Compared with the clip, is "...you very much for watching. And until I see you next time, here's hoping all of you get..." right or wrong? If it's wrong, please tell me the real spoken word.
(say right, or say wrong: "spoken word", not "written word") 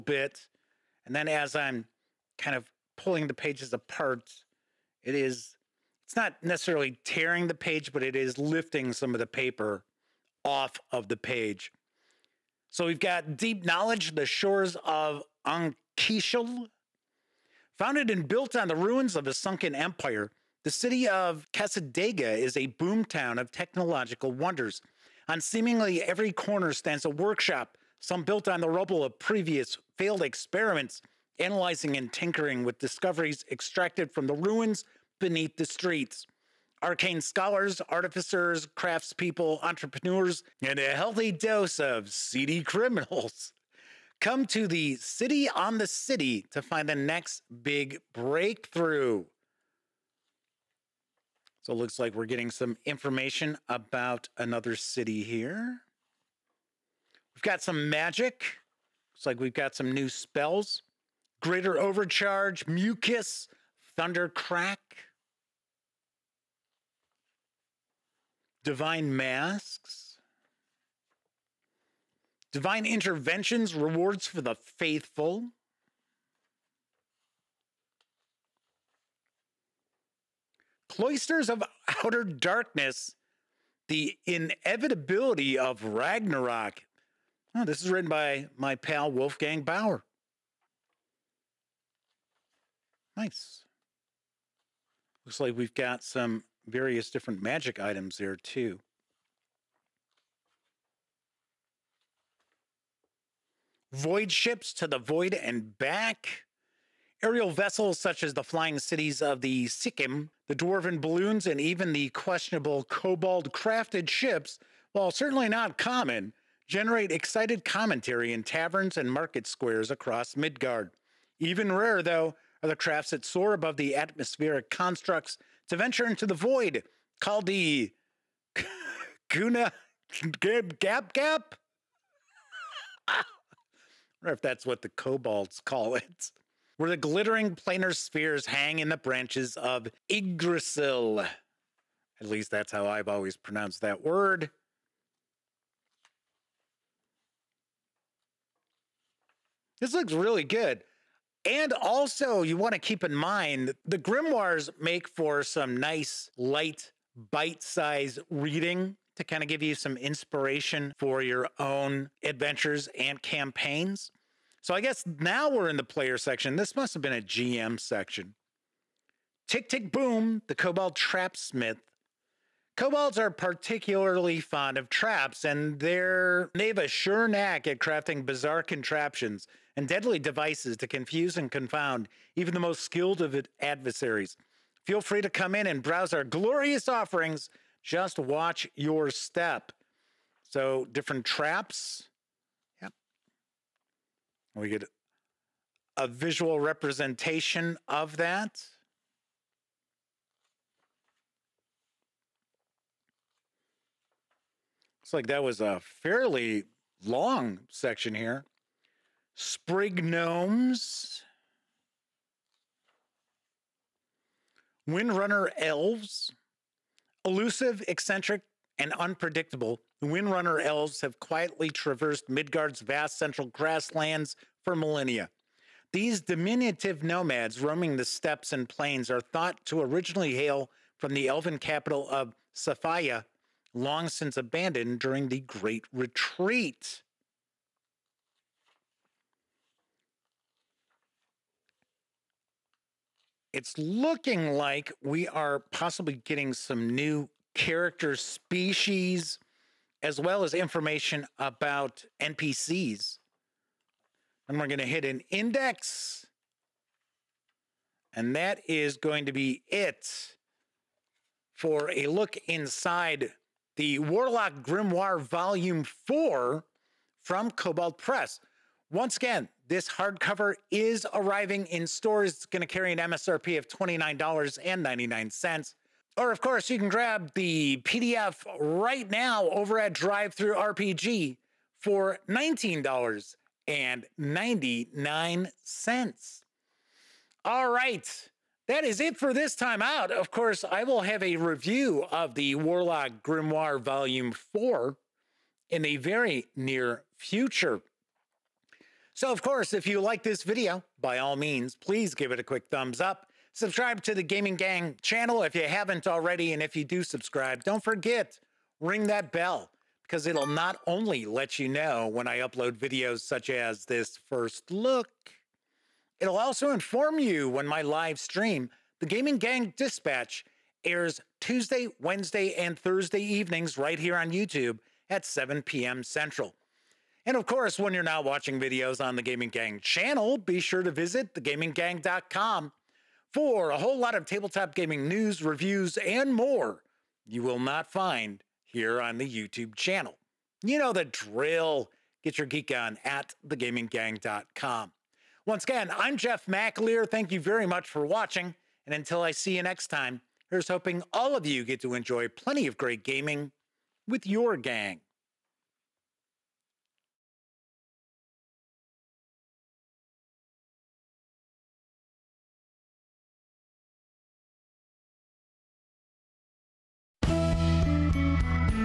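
right.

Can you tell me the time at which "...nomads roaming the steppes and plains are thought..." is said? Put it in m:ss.
3:47.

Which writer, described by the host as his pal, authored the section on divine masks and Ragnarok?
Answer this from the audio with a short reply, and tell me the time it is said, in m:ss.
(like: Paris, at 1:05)
Wolfgang Bauer, at 1:29.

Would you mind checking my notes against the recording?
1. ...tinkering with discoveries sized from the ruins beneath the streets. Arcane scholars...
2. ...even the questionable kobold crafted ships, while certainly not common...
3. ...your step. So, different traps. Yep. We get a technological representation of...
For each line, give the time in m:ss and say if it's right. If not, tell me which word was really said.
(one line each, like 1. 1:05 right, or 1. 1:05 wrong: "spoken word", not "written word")
1. 0:32 wrong: "extracted", not "sized"
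2. 1:51 right
3. 3:08 wrong: "visual", not "technological".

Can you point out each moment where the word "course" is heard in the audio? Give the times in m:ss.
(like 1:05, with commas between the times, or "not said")
4:36, 4:50, 4:59, 5:27.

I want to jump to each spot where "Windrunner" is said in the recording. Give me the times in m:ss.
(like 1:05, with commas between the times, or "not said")
3:34, 3:40.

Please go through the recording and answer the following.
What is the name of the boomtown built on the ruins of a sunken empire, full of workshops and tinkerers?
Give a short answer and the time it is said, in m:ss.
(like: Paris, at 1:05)
Casadega, at 0:21.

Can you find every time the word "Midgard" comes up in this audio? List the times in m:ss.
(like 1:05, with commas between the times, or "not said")
2:00, 3:42.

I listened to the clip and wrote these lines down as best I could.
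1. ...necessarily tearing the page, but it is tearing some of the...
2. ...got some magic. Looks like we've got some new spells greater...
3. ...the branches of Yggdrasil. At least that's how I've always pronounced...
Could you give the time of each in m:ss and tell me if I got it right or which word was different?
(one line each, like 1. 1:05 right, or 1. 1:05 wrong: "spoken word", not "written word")
1. 0:06 wrong: "lifting", not "tearing"
2. 0:57 right
3. 2:18 right.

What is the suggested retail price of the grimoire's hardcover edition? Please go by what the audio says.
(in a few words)
$29.99.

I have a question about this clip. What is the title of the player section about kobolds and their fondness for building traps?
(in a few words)
Tick, tick, boom.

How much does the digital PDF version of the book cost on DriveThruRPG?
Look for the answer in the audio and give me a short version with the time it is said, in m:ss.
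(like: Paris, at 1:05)
$19.99, at 4:42.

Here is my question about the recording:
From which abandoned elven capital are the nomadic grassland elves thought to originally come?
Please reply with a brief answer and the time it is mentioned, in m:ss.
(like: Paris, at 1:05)
Safaya, at 3:52.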